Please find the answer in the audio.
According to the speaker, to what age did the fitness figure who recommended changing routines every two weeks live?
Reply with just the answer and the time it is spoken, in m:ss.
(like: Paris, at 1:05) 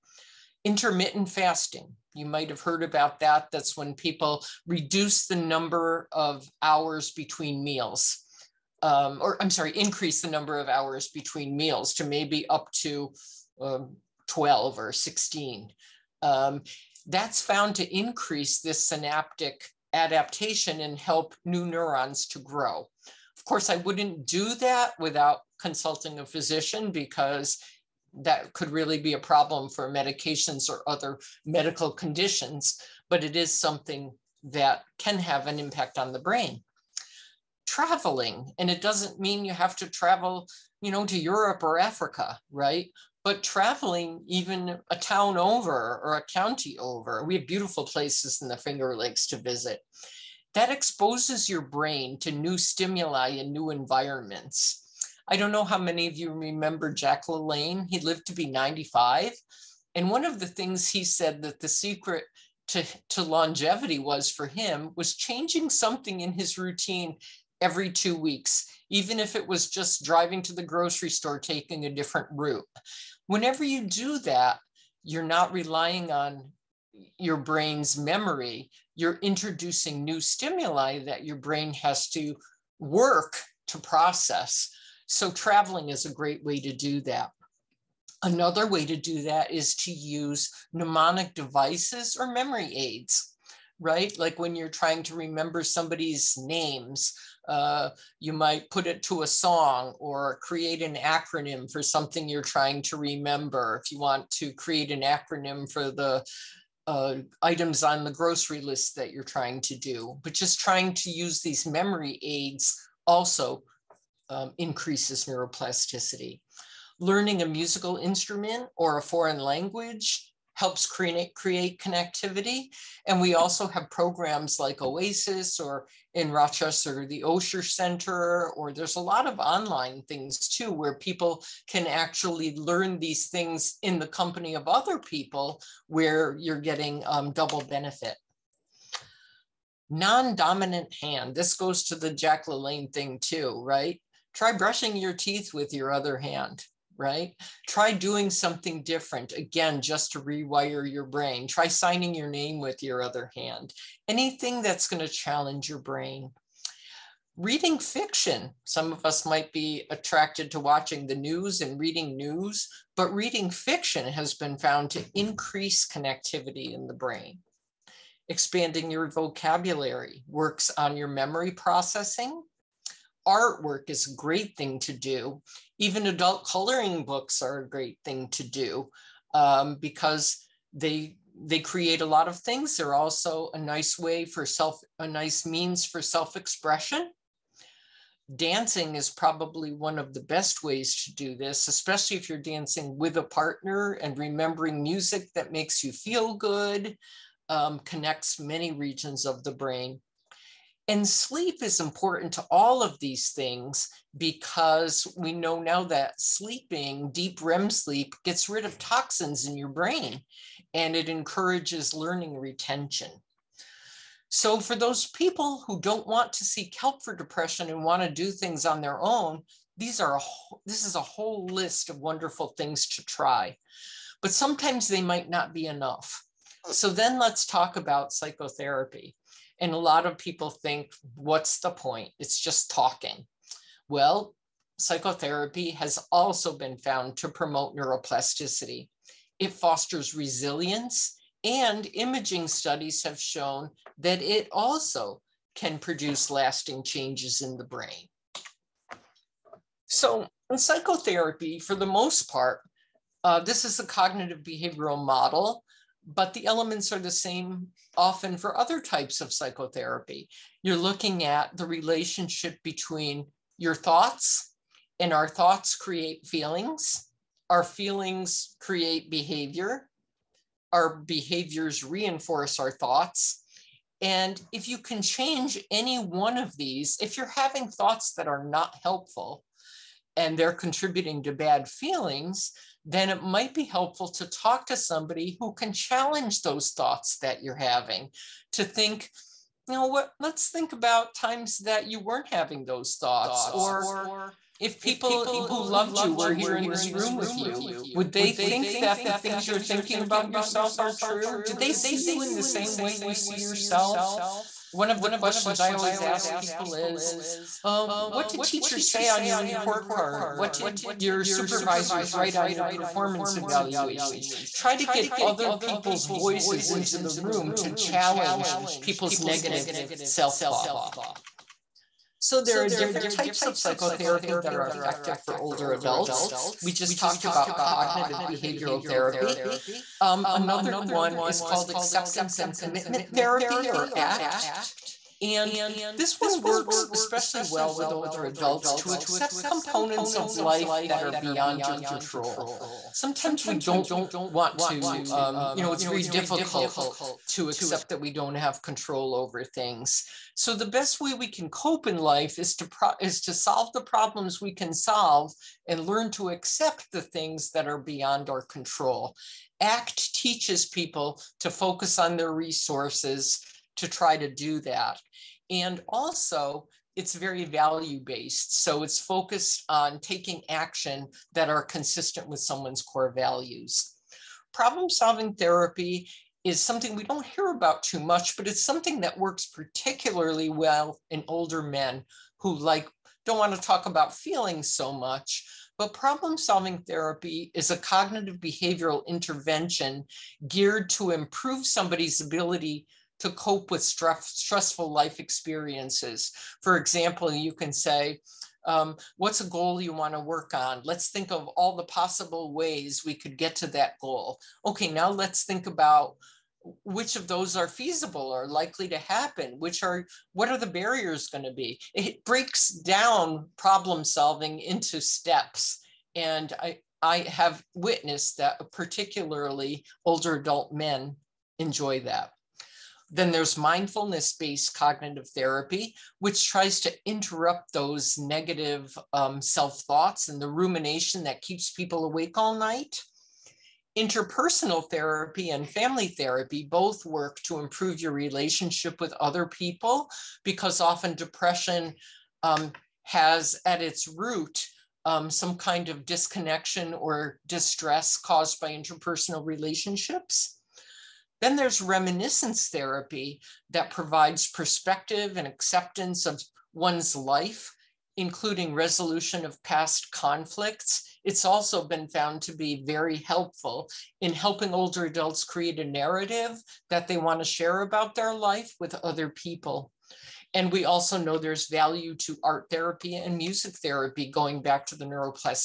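95, at 0:58.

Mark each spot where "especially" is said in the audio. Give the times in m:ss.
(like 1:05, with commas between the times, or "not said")
3:11, 5:36.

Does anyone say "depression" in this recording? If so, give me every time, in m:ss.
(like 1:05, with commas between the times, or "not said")
3:37, 7:21.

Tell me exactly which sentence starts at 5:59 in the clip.
ACT teaches people to focus on their resources to try to do that.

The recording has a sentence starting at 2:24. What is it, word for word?
Try brushing your teeth with your other hand, right?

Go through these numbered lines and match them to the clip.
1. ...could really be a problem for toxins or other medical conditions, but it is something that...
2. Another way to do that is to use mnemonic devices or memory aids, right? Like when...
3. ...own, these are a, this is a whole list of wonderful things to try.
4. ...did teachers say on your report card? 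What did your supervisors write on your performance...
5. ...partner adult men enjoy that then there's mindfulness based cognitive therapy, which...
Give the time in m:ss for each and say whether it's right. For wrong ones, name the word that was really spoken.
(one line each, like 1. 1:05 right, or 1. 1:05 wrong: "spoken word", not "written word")
1. 0:28 wrong: "medications", not "toxins"
2. 1:28 right
3. 3:39 right
4. 5:08 right
5. 7:00 wrong: "older", not "partner".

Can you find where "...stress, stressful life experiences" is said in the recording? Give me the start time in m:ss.
6:33.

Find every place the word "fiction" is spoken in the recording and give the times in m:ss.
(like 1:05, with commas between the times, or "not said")
2:37, 2:43.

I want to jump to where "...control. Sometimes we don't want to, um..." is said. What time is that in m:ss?
5:41.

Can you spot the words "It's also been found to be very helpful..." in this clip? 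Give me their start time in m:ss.
7:41.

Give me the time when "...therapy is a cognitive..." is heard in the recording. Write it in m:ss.
6:26.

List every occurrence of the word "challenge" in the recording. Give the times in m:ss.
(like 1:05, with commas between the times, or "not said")
2:35, 4:45, 5:17.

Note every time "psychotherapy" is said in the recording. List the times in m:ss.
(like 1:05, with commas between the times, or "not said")
3:48, 3:54, 4:10, 4:19, 5:23.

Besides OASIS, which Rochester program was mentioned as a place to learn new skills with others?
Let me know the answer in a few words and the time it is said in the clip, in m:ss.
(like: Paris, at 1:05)
Osher Center, at 2:07.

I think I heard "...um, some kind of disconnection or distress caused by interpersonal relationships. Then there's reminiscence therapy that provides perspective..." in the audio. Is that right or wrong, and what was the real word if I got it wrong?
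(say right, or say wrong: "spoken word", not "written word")
right.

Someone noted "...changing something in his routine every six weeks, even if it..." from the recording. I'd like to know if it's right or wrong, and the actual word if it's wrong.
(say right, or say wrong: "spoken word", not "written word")
wrong: "two", not "six".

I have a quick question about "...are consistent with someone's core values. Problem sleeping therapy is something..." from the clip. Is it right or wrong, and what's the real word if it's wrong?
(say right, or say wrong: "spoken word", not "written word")
wrong: "solving", not "sleeping".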